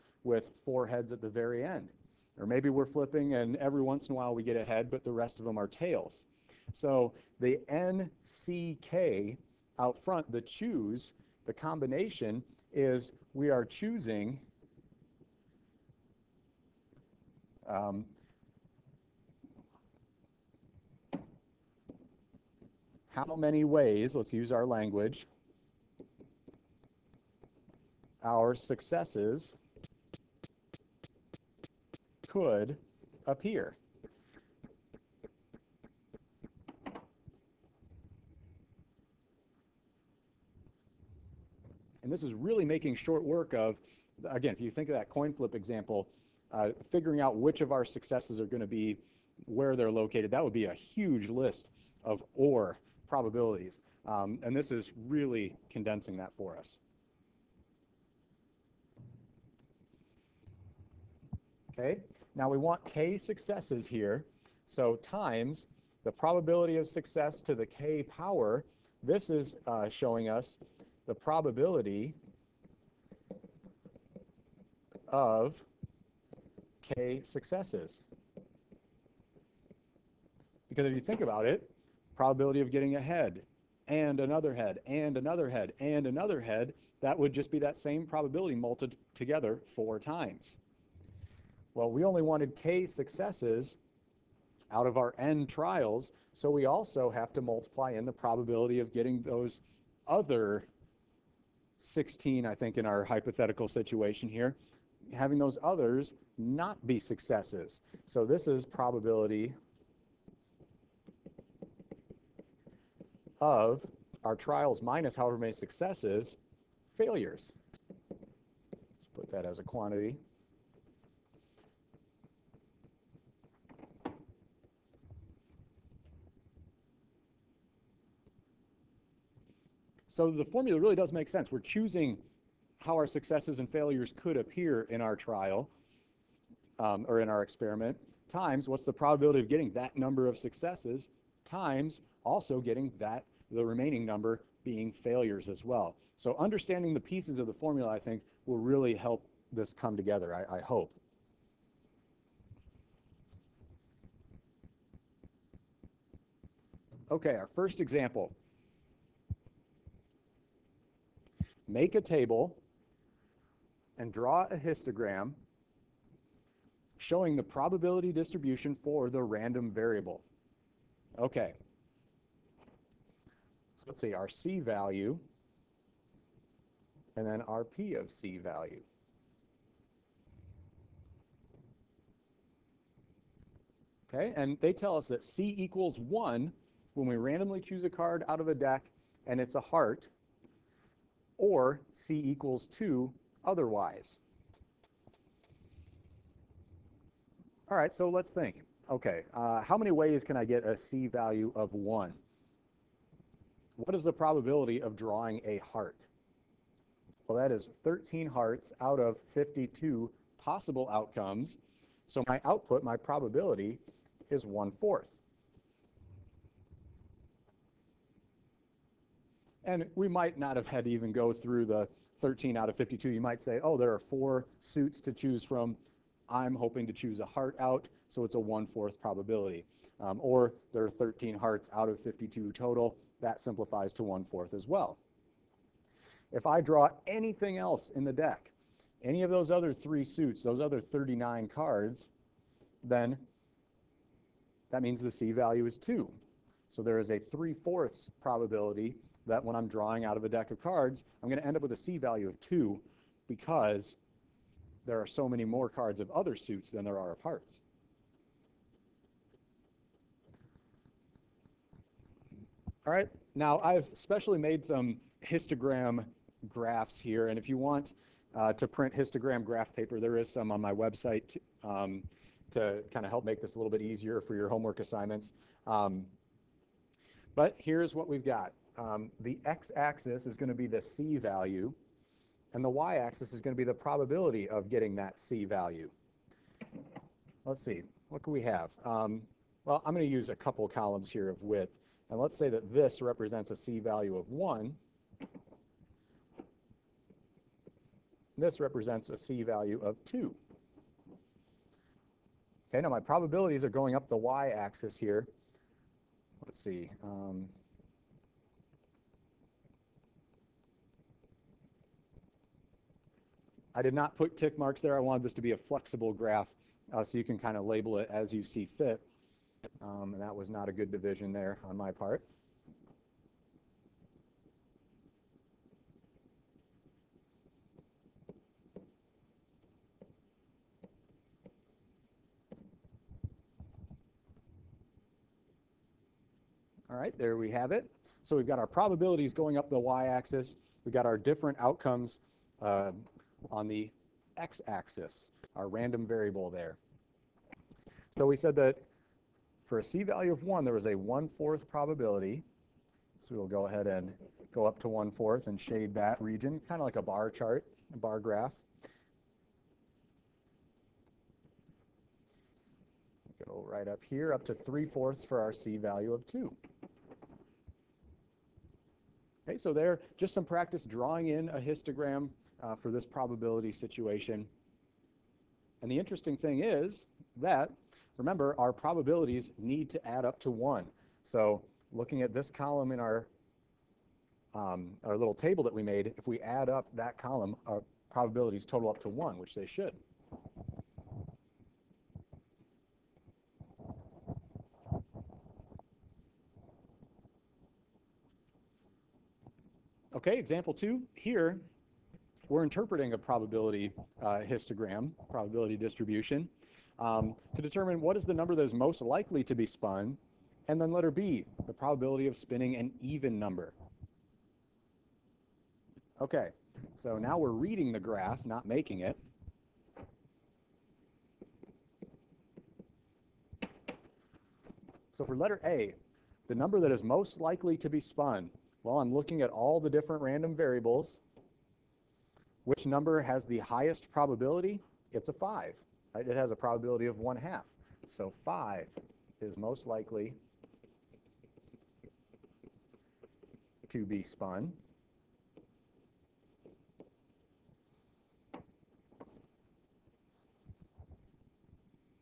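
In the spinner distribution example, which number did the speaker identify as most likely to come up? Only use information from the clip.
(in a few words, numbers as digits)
5.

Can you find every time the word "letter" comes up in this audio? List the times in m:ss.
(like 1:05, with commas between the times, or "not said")
6:50, 7:05.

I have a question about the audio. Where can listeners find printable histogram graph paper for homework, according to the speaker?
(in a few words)
My website.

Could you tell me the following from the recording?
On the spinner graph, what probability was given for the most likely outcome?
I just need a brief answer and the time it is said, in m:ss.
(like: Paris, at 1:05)
1/2, at 7:17.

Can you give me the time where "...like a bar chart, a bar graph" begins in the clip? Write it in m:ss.
5:56.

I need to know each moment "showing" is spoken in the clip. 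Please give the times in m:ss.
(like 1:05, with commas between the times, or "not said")
1:09, 2:46.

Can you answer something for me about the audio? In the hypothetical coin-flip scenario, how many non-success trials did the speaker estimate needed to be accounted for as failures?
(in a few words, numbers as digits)
16.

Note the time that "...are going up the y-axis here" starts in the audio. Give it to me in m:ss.
5:03.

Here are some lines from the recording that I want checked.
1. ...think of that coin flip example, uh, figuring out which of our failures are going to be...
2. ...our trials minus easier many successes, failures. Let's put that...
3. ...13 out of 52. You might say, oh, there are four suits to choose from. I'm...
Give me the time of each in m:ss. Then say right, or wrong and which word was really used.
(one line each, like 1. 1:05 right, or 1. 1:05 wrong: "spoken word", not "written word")
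1. 0:44 wrong: "successes", not "failures"
2. 1:54 wrong: "however", not "easier"
3. 3:42 right.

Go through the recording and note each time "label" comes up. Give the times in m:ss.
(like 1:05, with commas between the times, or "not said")
5:17.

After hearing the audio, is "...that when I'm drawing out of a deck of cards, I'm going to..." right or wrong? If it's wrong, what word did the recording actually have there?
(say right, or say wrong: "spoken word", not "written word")
right.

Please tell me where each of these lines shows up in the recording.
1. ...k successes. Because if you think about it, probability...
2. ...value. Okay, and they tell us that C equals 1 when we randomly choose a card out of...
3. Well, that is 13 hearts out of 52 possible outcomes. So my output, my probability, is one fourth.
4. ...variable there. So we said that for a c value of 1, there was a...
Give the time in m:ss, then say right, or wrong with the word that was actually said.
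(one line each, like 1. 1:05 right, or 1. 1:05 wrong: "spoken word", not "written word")
1. 1:16 right
2. 2:58 right
3. 3:27 right
4. 5:46 right.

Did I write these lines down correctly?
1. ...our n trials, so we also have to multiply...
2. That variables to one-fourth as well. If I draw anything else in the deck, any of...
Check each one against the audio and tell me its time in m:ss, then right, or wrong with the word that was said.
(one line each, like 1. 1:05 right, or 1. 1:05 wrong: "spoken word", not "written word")
1. 1:34 right
2. 3:53 wrong: "simplifies", not "variables".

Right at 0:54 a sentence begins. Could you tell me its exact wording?
Um, and this is really condensing that for us.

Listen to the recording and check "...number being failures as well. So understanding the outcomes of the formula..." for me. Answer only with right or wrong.
wrong.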